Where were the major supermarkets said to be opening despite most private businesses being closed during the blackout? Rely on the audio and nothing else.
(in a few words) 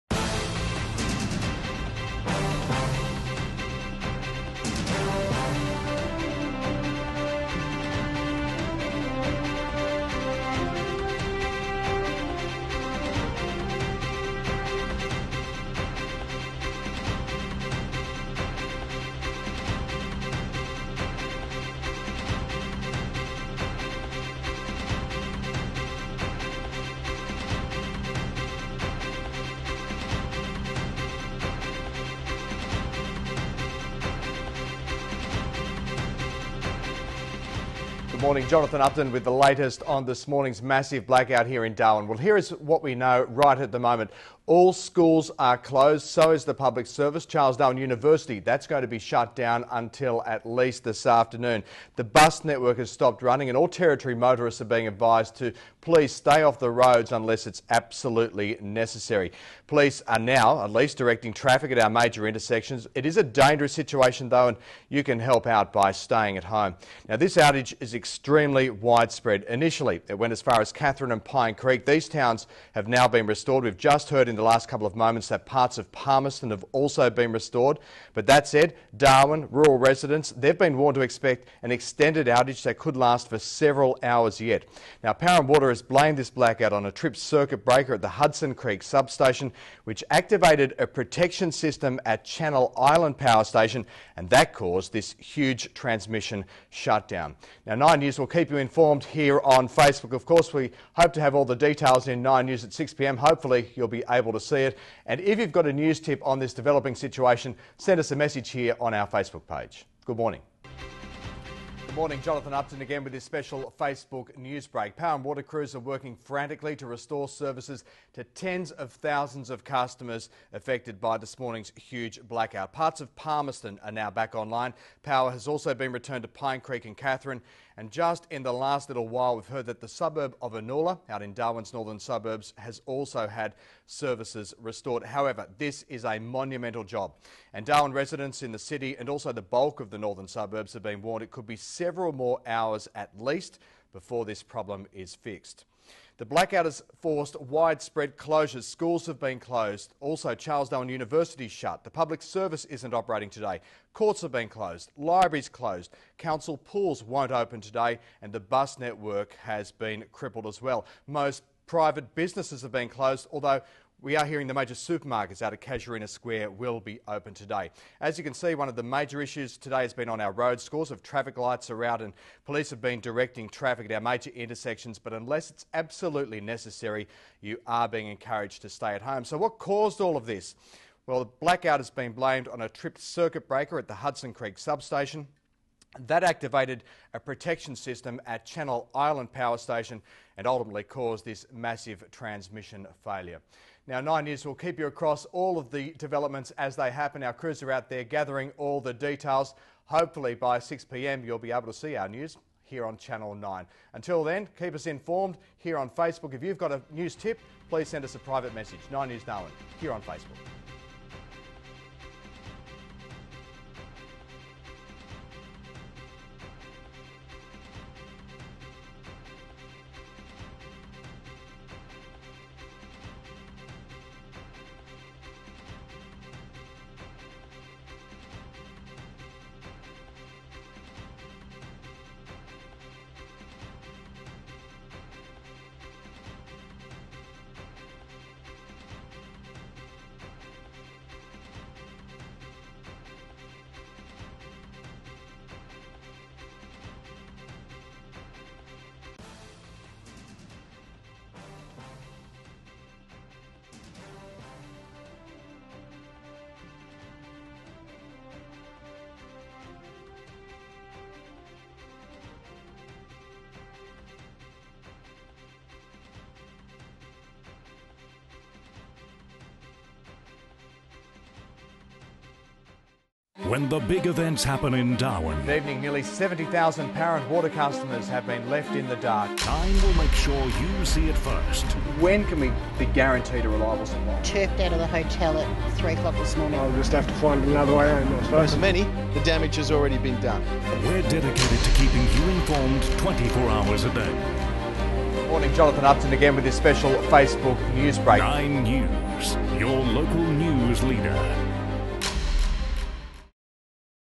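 Casuarina Square.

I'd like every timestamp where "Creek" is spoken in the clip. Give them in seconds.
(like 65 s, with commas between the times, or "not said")
71 s, 88 s, 126 s, 184 s.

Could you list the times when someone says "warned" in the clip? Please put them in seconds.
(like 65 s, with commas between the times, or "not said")
80 s, 141 s.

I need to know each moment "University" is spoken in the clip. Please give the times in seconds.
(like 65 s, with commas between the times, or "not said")
47 s, 150 s.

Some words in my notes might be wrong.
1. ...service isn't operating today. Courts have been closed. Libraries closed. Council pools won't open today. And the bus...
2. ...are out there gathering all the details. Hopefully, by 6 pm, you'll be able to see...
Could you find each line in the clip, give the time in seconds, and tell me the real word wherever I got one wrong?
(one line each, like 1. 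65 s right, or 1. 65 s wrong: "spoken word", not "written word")
1. 152 s right
2. 197 s right.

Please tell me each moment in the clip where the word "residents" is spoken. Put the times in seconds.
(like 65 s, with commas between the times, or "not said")
79 s, 137 s.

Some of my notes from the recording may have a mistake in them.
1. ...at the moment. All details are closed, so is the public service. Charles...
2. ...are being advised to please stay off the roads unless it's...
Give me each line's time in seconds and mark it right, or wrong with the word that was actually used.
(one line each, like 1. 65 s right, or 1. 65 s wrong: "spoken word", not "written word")
1. 43 s wrong: "schools", not "details"
2. 54 s right.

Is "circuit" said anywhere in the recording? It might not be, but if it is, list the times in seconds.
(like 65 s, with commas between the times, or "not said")
87 s, 183 s.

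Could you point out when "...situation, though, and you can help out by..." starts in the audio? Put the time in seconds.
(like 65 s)
63 s.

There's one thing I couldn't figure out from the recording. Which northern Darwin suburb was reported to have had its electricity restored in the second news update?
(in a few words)
Anula.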